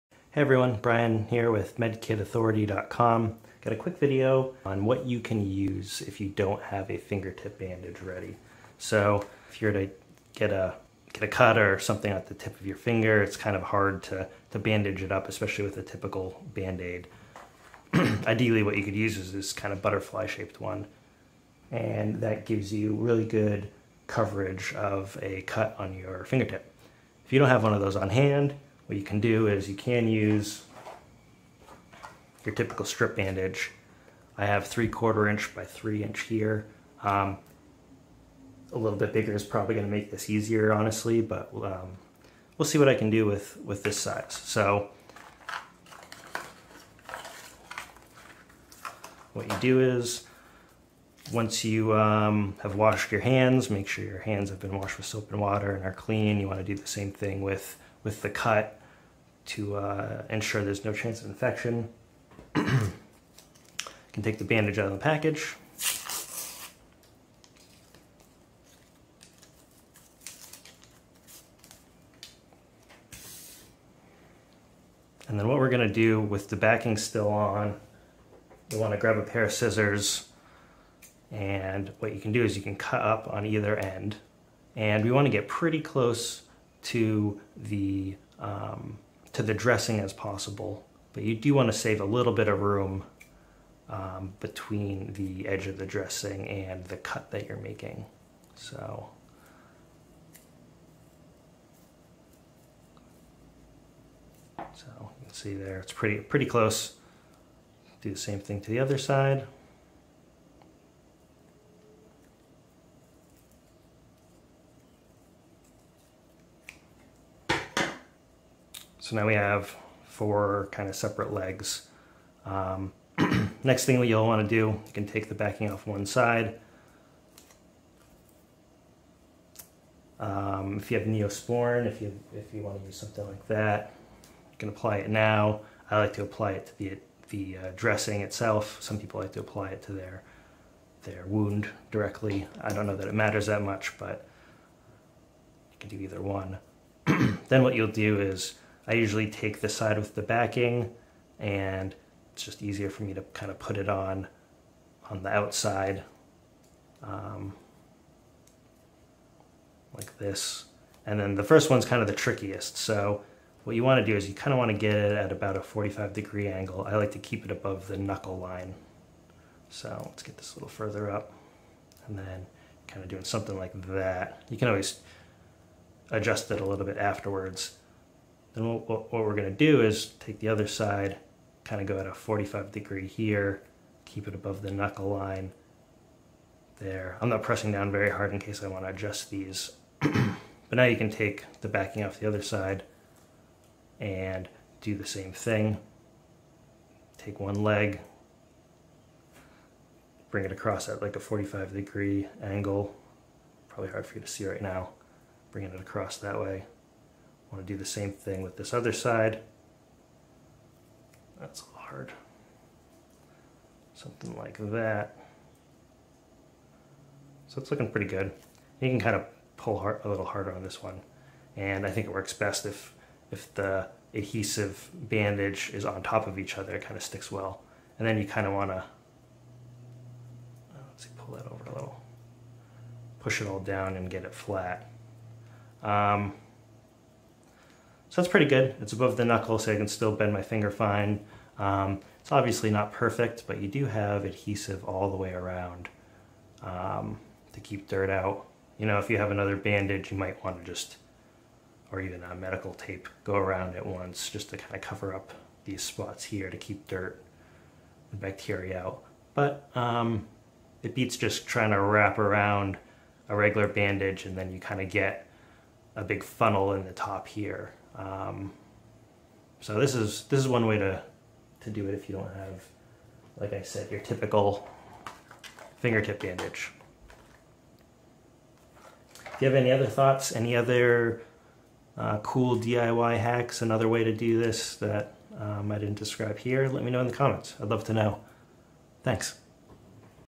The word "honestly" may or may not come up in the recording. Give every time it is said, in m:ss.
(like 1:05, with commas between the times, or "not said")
0:40.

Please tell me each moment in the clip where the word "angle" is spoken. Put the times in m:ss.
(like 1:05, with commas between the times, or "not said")
2:46, 3:22.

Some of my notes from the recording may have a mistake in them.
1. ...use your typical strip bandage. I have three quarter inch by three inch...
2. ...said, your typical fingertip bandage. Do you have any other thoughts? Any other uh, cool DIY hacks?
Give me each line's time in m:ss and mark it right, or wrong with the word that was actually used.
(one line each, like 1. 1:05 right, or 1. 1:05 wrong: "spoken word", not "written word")
1. 0:30 right
2. 4:33 right.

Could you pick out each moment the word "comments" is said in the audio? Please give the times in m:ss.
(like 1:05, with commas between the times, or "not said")
4:47.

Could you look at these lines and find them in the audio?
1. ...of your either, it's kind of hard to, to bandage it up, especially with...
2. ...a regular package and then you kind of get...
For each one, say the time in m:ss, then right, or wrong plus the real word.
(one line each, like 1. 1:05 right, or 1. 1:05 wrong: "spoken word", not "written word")
1. 0:12 wrong: "finger", not "either"
2. 4:23 wrong: "bandage", not "package".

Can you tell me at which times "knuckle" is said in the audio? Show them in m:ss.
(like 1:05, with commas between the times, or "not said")
2:47, 3:04, 3:59.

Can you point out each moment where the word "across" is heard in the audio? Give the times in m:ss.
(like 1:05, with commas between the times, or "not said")
3:20, 3:25.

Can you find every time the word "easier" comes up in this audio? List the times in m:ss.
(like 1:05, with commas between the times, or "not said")
0:40, 2:32.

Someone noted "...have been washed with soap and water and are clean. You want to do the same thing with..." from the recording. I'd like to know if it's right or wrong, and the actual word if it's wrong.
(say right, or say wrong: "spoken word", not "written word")
right.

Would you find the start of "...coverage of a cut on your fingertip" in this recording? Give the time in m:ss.
0:24.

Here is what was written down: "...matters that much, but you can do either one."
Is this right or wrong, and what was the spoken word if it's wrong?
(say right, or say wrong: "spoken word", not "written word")
right.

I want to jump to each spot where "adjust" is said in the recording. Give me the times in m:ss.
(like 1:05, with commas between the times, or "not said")
2:56, 3:08.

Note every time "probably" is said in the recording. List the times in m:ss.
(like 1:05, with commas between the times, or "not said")
0:39, 3:23.